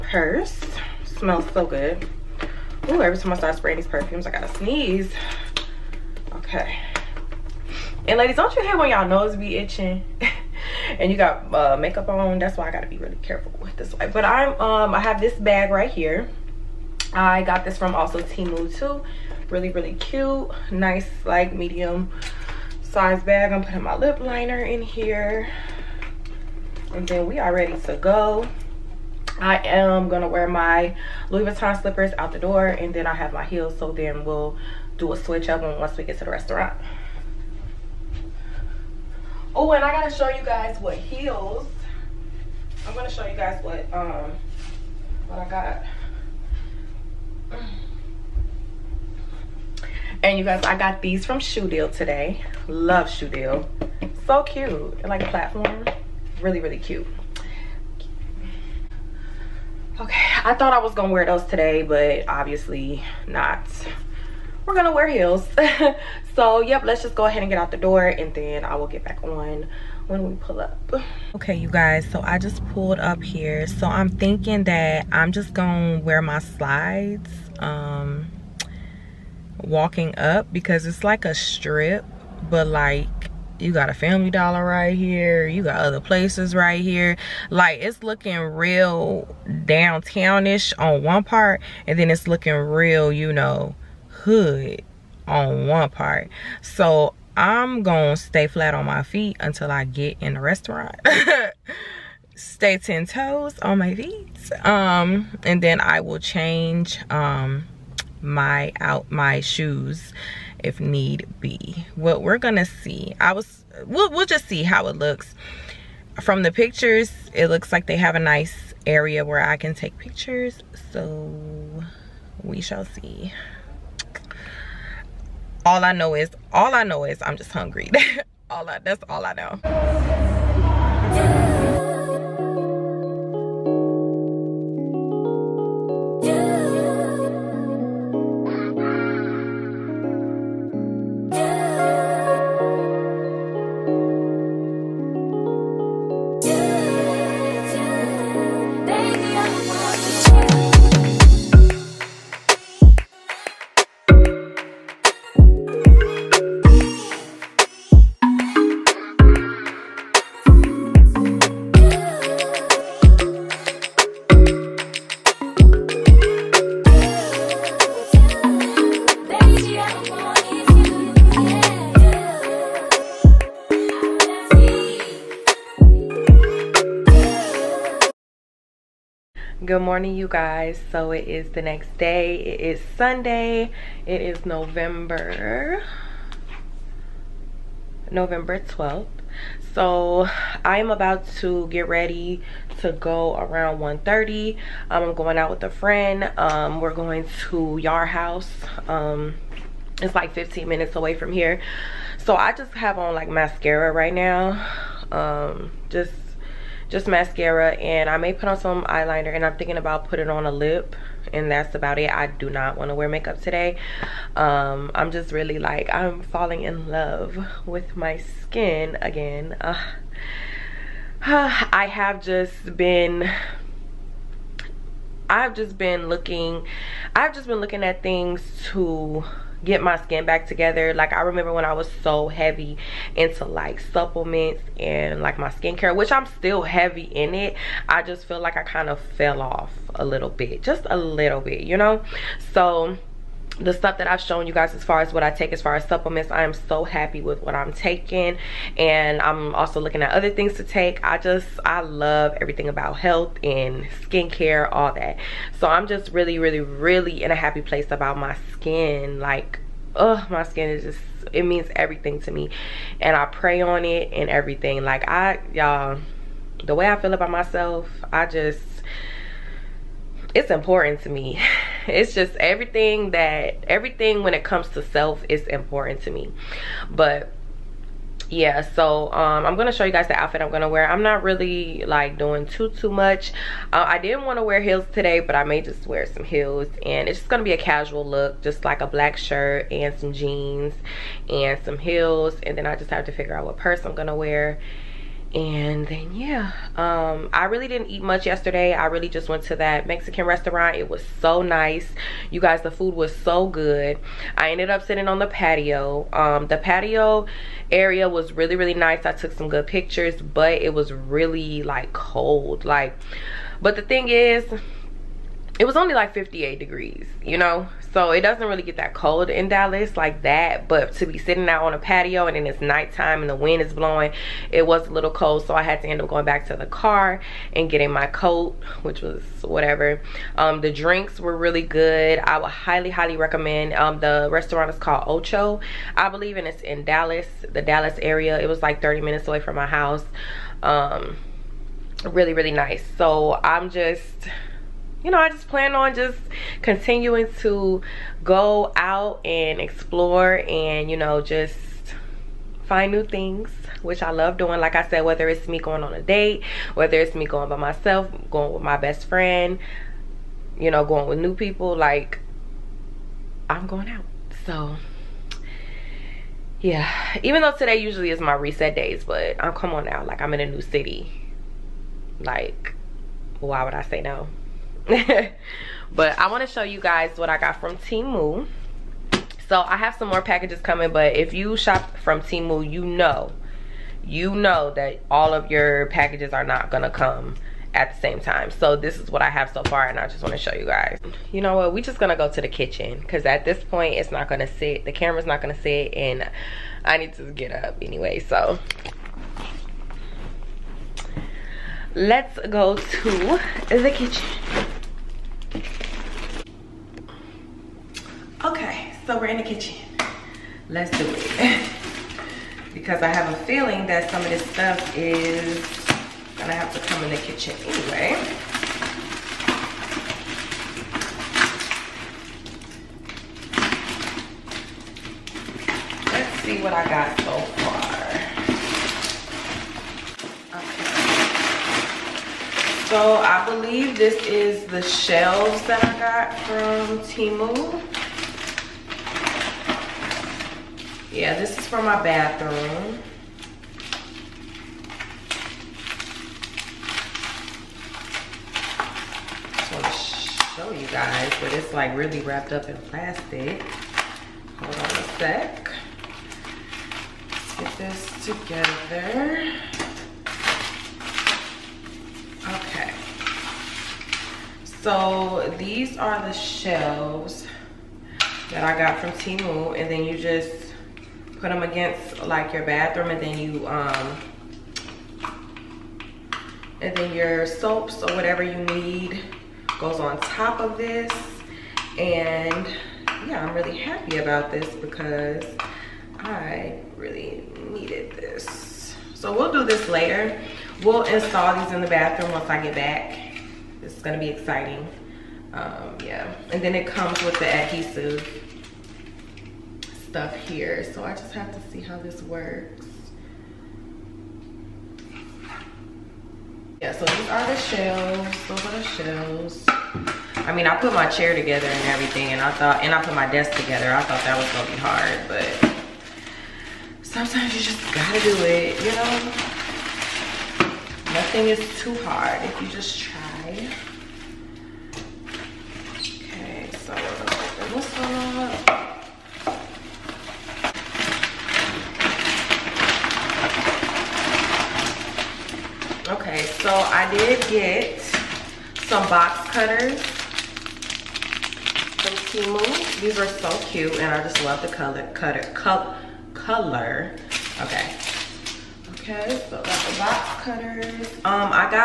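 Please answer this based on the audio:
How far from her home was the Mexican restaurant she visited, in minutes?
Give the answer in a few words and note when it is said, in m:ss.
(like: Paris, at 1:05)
30 minutes, at 5:38.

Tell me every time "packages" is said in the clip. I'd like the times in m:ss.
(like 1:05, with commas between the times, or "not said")
6:20, 6:25.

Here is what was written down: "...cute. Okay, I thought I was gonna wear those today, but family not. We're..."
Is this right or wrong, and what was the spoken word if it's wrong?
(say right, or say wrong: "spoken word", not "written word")
wrong: "obviously", not "family".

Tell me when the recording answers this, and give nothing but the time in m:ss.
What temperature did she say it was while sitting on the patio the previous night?
5:16.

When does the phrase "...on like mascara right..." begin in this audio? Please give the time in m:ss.
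3:22.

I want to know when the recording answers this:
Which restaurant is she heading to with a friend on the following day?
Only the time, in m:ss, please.
3:17.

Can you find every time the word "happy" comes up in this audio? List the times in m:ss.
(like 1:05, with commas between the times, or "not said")
4:06, 4:17, 8:03.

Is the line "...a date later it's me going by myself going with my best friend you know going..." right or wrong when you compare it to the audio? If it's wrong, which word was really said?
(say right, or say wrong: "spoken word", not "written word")
wrong: "whether", not "later".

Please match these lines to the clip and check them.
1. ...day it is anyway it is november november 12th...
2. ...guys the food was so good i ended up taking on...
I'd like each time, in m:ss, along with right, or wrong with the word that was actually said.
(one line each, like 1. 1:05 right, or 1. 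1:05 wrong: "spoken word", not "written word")
1. 3:01 wrong: "sunday", not "anyway"
2. 5:02 wrong: "sitting", not "taking".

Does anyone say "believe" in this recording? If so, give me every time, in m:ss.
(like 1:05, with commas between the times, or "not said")
5:36, 7:13.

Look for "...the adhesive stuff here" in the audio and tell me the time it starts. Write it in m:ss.
8:17.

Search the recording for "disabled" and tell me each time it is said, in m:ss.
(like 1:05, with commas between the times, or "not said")
not said.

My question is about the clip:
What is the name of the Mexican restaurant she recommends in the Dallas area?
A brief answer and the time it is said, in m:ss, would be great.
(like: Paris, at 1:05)
Ocho, at 5:35.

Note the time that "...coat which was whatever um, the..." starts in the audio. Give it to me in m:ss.
5:28.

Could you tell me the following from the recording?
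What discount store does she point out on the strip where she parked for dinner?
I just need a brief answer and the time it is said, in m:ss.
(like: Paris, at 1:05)
Family Dollar, at 1:23.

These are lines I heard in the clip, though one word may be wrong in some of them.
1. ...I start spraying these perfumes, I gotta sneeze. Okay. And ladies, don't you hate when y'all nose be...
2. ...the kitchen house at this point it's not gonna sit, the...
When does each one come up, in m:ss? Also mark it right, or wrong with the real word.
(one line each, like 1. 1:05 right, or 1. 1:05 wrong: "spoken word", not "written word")
1. 0:03 right
2. 6:32 wrong: "cause", not "house".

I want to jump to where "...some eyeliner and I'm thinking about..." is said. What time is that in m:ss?
3:28.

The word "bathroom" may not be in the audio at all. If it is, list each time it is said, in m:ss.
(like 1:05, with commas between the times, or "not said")
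7:22, 7:52, 8:11.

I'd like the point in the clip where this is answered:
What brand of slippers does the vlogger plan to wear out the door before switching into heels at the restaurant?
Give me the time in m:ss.
0:31.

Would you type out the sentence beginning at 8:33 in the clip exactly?
I thought that was gonna be hard, but sometimes you just gotta do it, you know?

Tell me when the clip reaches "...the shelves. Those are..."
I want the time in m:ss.
8:27.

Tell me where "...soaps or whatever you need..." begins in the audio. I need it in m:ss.
7:57.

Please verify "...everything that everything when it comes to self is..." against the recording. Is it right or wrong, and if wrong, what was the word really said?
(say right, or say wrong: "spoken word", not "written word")
right.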